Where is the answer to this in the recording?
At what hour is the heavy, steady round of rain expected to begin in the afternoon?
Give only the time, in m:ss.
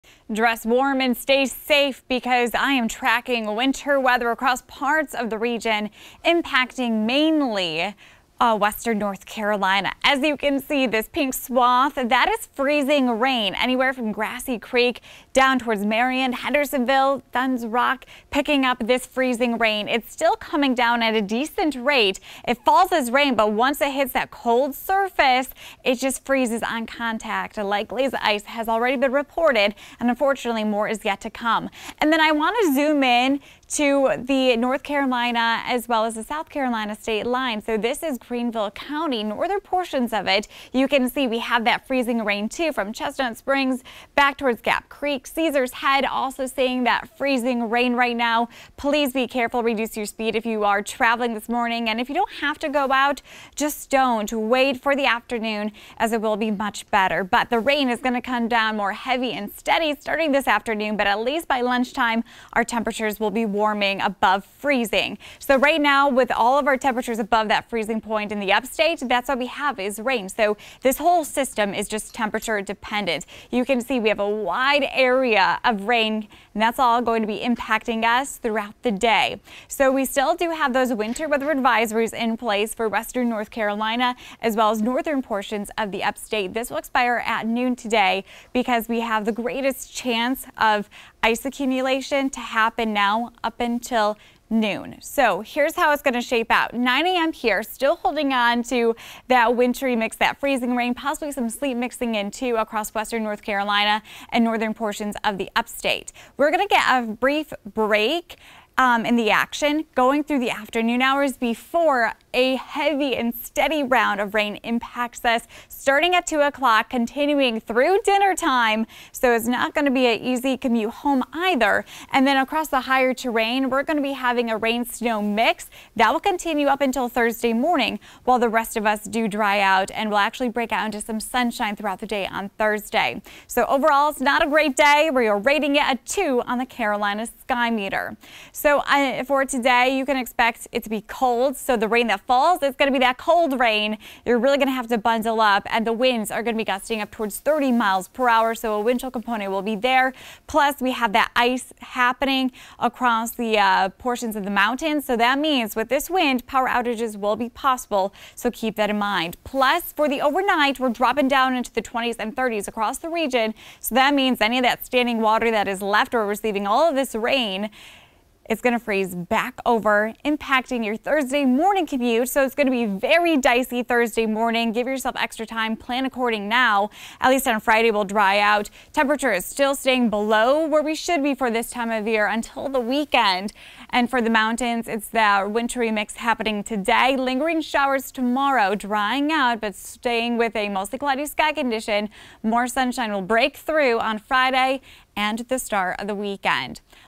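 1:56.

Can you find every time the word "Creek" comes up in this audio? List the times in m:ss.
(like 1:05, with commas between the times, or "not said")
0:14, 0:44.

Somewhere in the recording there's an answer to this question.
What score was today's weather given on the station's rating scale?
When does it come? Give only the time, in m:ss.
2:15.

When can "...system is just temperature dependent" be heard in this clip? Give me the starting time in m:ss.
1:11.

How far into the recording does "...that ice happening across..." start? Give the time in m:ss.
2:31.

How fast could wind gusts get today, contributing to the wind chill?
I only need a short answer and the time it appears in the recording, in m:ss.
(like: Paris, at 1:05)
30 mph, at 2:27.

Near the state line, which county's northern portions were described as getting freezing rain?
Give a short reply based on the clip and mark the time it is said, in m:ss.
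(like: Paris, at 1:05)
Greenville County, at 0:38.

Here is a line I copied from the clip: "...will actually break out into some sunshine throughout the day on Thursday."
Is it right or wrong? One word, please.
right.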